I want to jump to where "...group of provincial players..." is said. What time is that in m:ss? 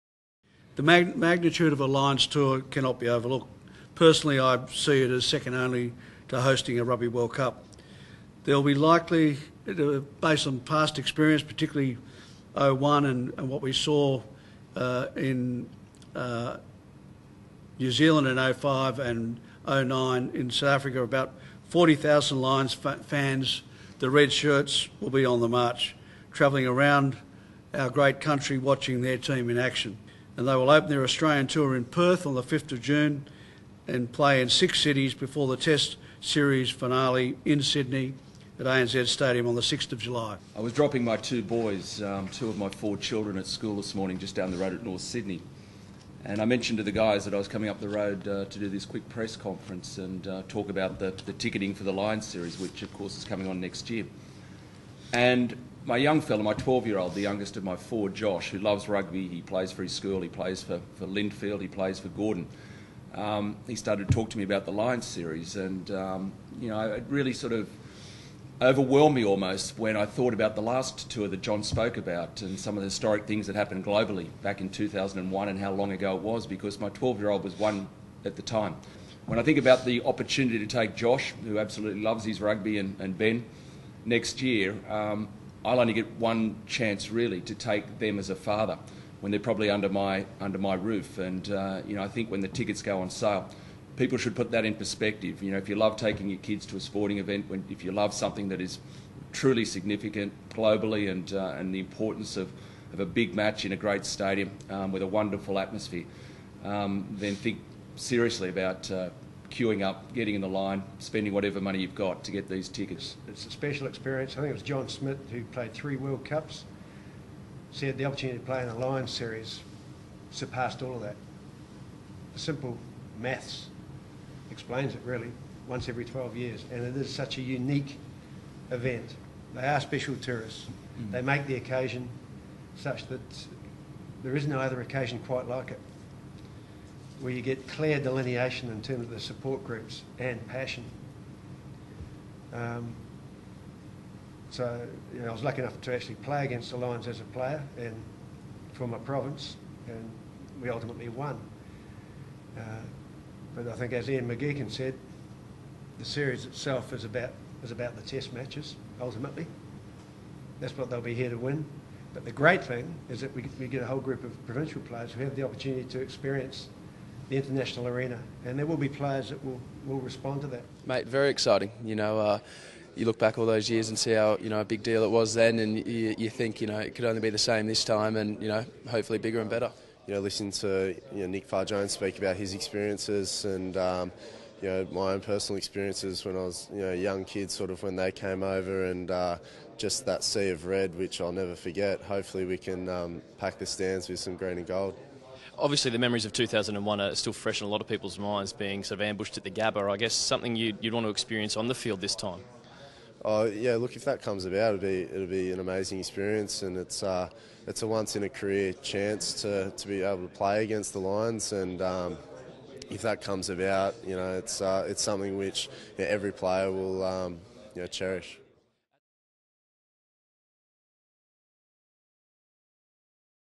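2:43.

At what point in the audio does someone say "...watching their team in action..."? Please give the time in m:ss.
0:28.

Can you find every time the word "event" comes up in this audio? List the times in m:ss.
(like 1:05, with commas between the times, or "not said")
1:37, 2:08.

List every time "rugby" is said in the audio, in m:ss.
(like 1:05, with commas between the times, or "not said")
0:06, 0:58, 1:22.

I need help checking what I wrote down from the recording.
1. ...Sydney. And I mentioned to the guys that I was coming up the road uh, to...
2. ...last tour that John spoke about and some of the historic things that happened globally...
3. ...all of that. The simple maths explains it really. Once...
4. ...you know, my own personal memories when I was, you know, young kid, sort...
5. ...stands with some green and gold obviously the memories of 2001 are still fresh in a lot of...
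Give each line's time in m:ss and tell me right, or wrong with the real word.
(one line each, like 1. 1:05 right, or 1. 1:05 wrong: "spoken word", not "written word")
1. 0:45 right
2. 1:10 right
3. 2:00 right
4. 3:04 wrong: "experiences", not "memories"
5. 3:13 right.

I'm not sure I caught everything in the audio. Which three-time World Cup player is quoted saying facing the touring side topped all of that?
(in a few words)
John Smit.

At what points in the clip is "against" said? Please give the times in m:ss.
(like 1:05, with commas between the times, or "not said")
2:26, 3:30.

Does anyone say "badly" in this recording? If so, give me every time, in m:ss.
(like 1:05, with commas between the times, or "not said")
not said.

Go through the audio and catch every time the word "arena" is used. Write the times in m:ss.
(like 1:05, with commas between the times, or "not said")
2:47.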